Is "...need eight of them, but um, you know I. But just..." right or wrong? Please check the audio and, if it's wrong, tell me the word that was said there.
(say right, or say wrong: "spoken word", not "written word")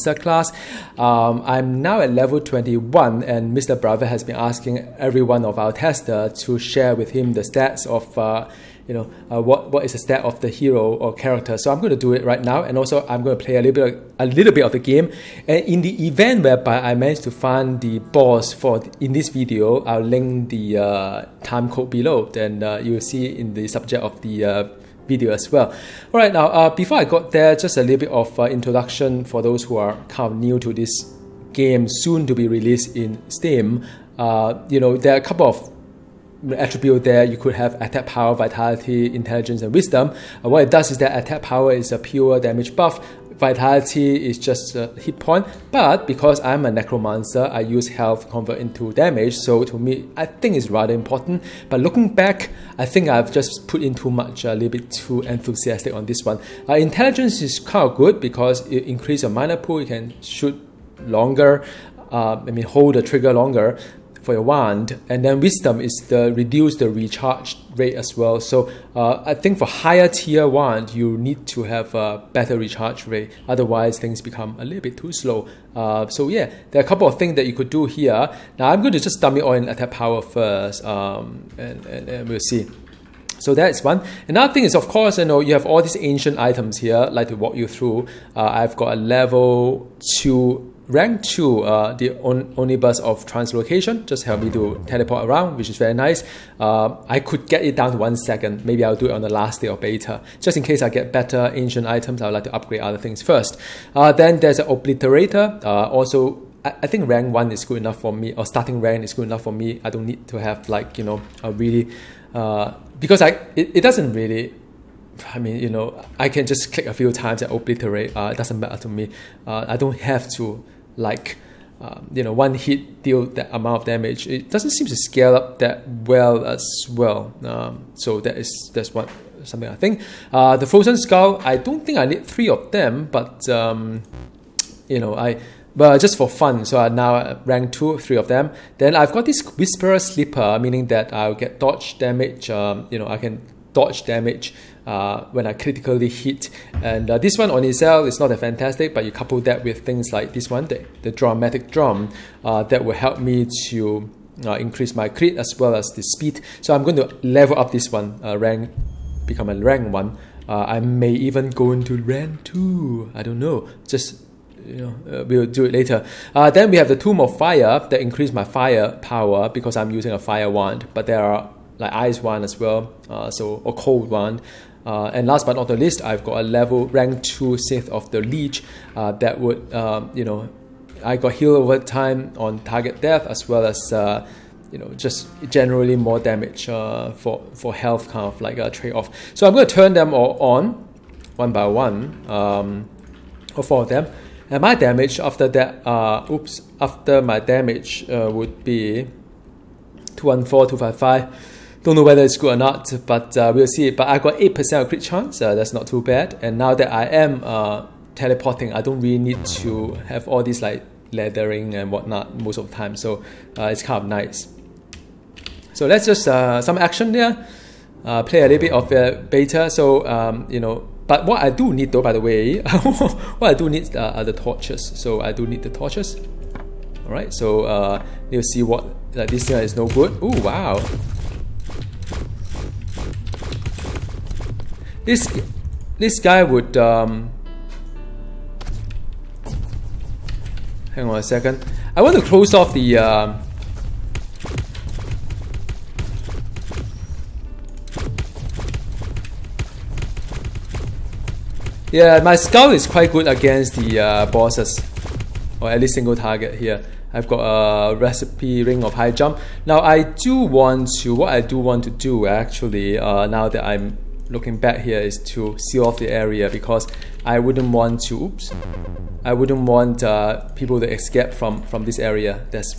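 wrong: "three", not "eight".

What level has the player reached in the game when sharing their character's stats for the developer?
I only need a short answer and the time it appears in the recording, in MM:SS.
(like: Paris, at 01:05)
21, at 00:02.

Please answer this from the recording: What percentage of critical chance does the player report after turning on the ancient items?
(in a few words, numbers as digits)
8%.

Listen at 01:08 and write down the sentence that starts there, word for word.
So uh, I think for higher tier wand, you need to have a better recharge rate.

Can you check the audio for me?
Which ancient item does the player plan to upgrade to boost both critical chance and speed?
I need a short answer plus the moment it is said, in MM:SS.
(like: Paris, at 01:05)
dramatic drum, at 02:31.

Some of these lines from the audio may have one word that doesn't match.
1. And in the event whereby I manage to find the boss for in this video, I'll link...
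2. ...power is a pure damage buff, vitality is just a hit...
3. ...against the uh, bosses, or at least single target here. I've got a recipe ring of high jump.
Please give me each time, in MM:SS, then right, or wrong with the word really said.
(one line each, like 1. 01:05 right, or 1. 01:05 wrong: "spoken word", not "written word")
1. 00:15 right
2. 00:41 right
3. 04:13 right.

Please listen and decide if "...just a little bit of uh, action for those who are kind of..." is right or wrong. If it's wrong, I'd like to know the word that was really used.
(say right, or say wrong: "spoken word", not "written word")
wrong: "introduction", not "action".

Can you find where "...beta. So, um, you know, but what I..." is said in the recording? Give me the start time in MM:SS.
03:39.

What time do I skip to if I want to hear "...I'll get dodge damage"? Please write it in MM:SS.
02:21.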